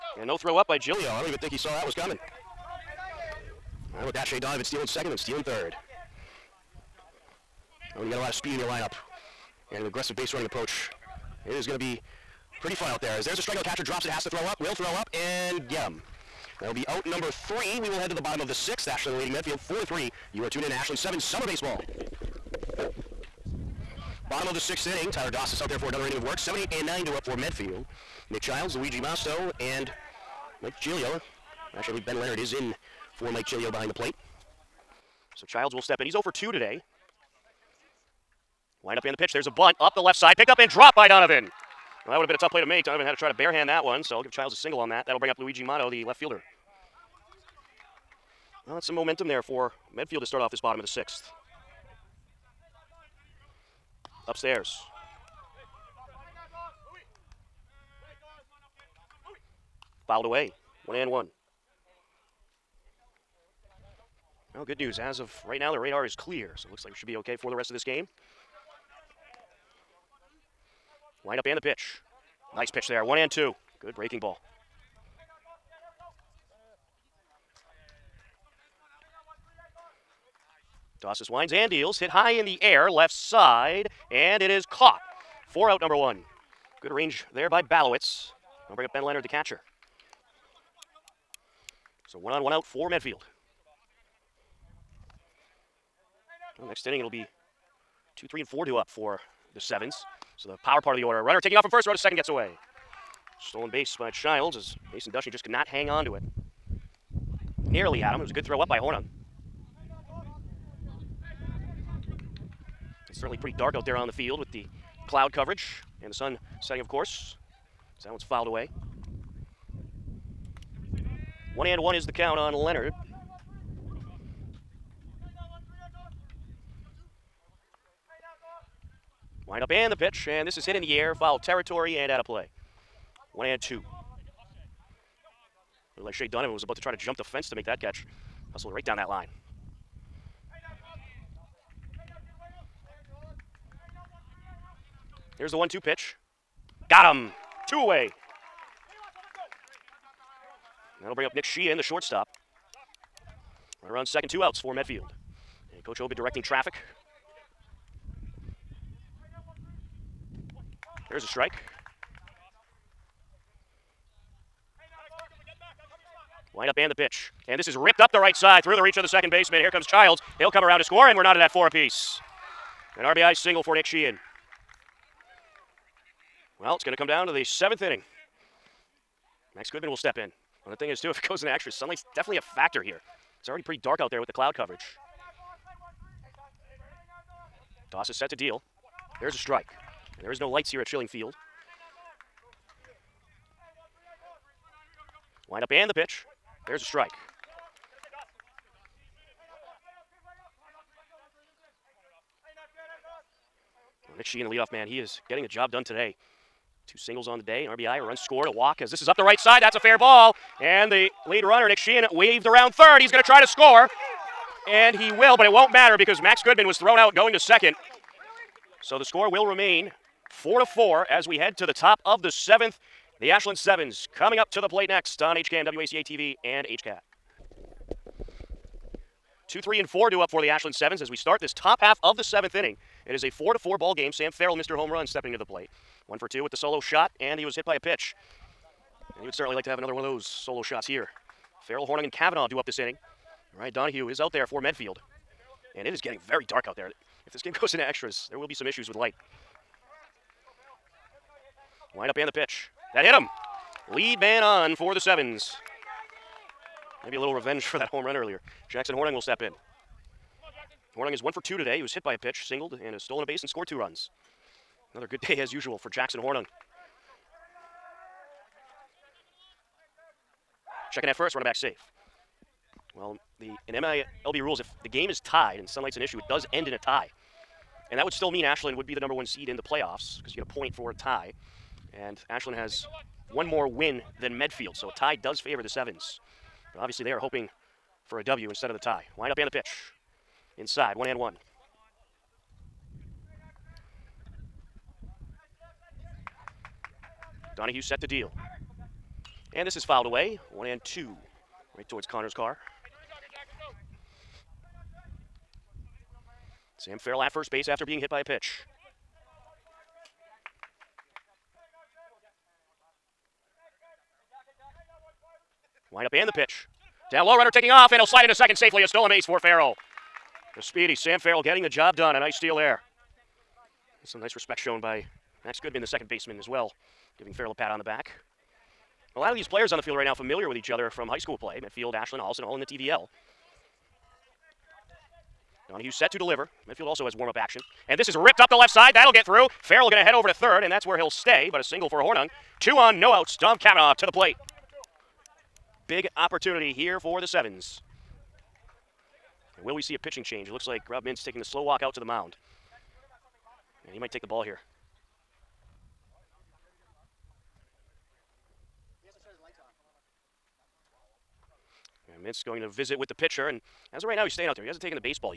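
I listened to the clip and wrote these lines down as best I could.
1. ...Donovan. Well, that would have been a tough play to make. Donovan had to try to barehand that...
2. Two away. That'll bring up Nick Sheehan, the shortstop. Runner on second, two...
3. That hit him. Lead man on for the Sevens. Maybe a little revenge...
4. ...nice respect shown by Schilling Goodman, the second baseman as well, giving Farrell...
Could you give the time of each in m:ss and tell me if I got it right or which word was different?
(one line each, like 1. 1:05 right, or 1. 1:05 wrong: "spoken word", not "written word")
1. 0:41 right
2. 2:27 right
3. 4:12 right
4. 5:24 wrong: "Max", not "Schilling".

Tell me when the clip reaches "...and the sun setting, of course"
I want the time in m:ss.
1:56.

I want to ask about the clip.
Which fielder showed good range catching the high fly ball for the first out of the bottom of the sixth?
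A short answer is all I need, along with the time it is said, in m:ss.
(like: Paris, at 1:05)
Balowitz, at 1:27.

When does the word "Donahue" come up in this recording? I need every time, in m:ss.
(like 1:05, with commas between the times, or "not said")
4:03, 4:57, 5:35.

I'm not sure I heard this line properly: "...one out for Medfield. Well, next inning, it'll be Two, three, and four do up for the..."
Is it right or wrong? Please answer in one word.
right.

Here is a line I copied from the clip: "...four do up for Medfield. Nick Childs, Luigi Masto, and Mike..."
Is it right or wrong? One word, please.
wrong.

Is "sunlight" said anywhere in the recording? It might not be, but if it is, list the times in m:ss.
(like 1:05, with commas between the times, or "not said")
3:01, 4:35.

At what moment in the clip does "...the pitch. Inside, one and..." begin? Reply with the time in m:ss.
4:49.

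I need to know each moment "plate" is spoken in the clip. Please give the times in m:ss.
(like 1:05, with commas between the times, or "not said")
0:33, 3:44, 3:55, 5:44.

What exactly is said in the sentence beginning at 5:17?
Down low, runner taking off, and he'll slide into second safely.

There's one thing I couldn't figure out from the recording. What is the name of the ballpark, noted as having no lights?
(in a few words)
Schilling Field.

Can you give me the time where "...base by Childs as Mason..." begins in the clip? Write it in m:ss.
1:43.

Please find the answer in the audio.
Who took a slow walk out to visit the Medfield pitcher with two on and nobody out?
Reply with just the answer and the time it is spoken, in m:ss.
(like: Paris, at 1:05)
Rob Mintz, at 5:50.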